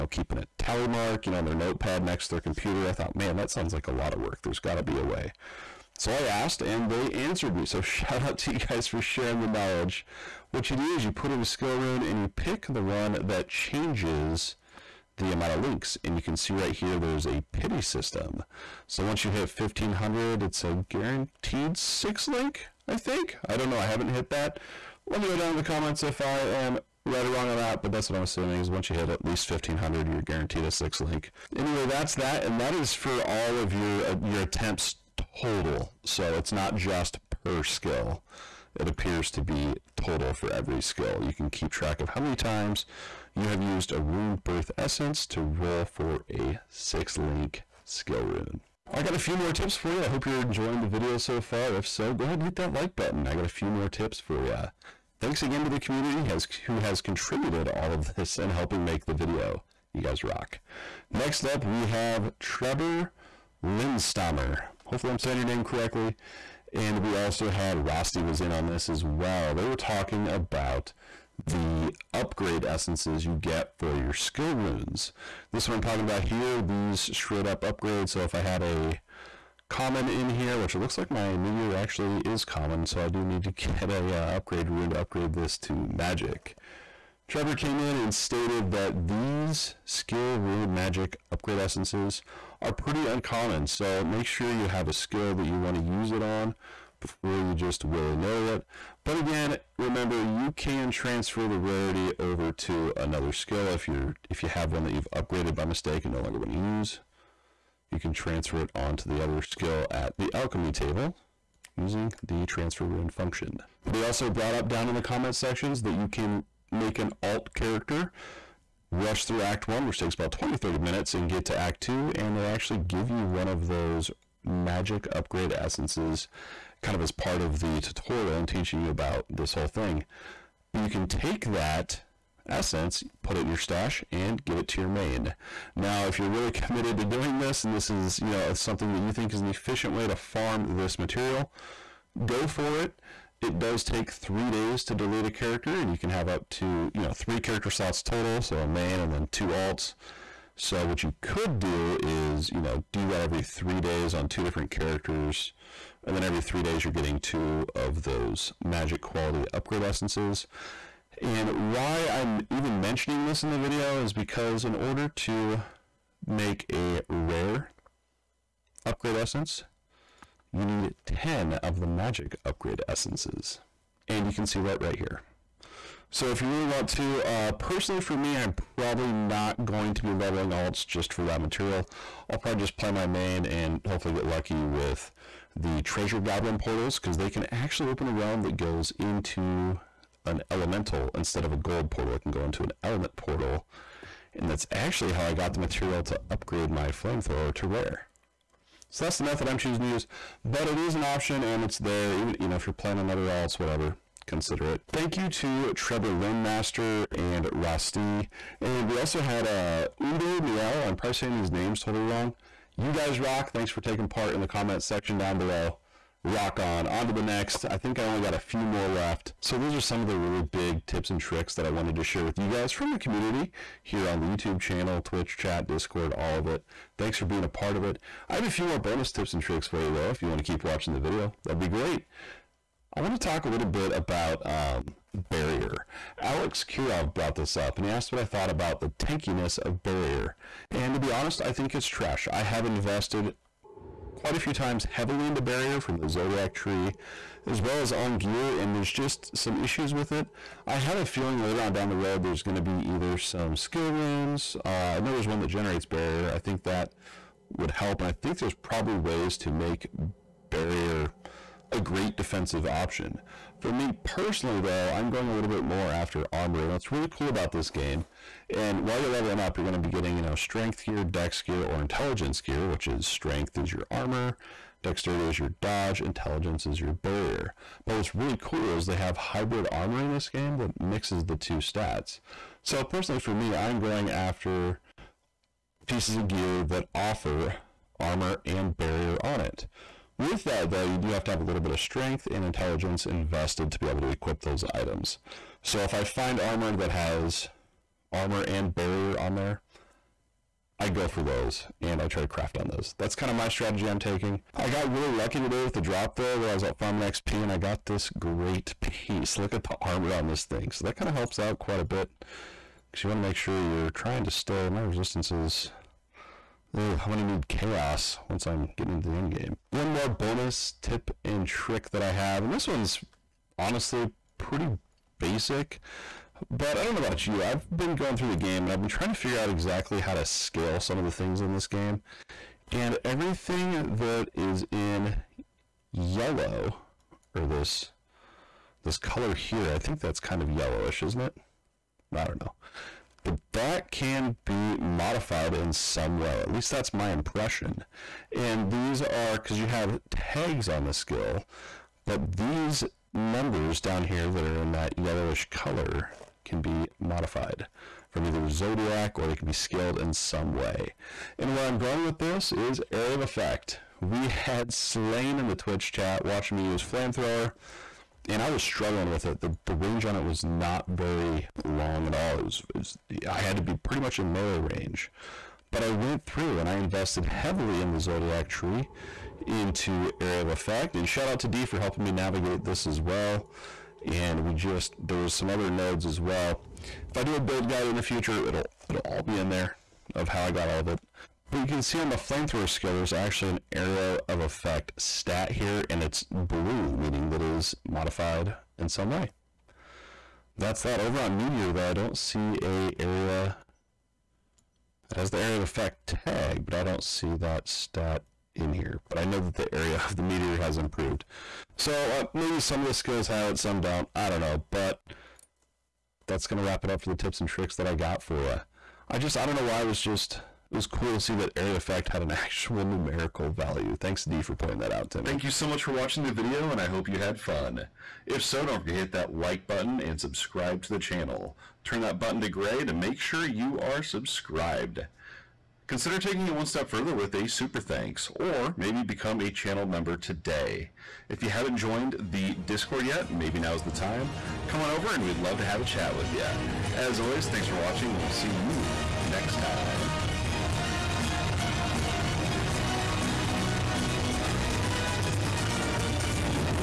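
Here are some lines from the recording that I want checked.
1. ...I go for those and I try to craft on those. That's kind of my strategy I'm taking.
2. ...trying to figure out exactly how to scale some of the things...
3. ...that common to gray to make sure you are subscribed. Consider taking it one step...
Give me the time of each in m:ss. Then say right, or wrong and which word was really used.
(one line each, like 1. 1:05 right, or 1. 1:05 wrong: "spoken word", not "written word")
1. 5:00 right
2. 5:28 right
3. 7:12 wrong: "button", not "common".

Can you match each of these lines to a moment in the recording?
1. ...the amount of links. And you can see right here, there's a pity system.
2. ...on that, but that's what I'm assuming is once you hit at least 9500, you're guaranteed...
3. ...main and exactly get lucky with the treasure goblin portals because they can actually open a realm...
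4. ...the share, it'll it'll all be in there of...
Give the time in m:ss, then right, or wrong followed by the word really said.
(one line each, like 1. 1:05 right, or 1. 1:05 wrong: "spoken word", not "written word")
1. 0:15 right
2. 0:27 wrong: "1500", not "9500"
3. 3:03 wrong: "hopefully", not "exactly"
4. 6:27 wrong: "future", not "share".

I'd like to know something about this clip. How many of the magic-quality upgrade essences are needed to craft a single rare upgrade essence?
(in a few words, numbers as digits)
10.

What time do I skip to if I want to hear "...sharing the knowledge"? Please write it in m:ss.
0:08.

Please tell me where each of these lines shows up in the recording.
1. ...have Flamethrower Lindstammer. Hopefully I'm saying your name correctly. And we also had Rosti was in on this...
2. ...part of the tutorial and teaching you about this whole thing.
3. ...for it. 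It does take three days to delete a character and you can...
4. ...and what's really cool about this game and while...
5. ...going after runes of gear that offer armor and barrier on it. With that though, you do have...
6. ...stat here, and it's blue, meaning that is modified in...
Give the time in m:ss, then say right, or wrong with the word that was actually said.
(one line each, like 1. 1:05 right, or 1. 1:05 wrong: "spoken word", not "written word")
1. 1:01 wrong: "Trevor", not "Flamethrower"
2. 2:07 right
3. 2:22 right
4. 4:26 right
5. 4:43 wrong: "pieces", not "runes"
6. 6:34 right.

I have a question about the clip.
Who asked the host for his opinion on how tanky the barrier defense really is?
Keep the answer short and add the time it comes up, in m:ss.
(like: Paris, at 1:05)
Alex Kirov, at 3:56.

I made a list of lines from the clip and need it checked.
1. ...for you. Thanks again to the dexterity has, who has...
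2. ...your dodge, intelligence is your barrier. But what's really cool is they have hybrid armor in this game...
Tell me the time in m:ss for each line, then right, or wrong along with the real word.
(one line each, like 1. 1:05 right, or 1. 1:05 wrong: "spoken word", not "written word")
1. 0:54 wrong: "community", not "dexterity"
2. 4:35 right.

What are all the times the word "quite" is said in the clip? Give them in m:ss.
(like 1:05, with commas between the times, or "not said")
4:04, 5:11.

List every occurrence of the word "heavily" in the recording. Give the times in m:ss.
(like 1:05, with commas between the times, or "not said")
4:04, 6:17.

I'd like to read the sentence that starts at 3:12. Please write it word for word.
It can go into an element portal.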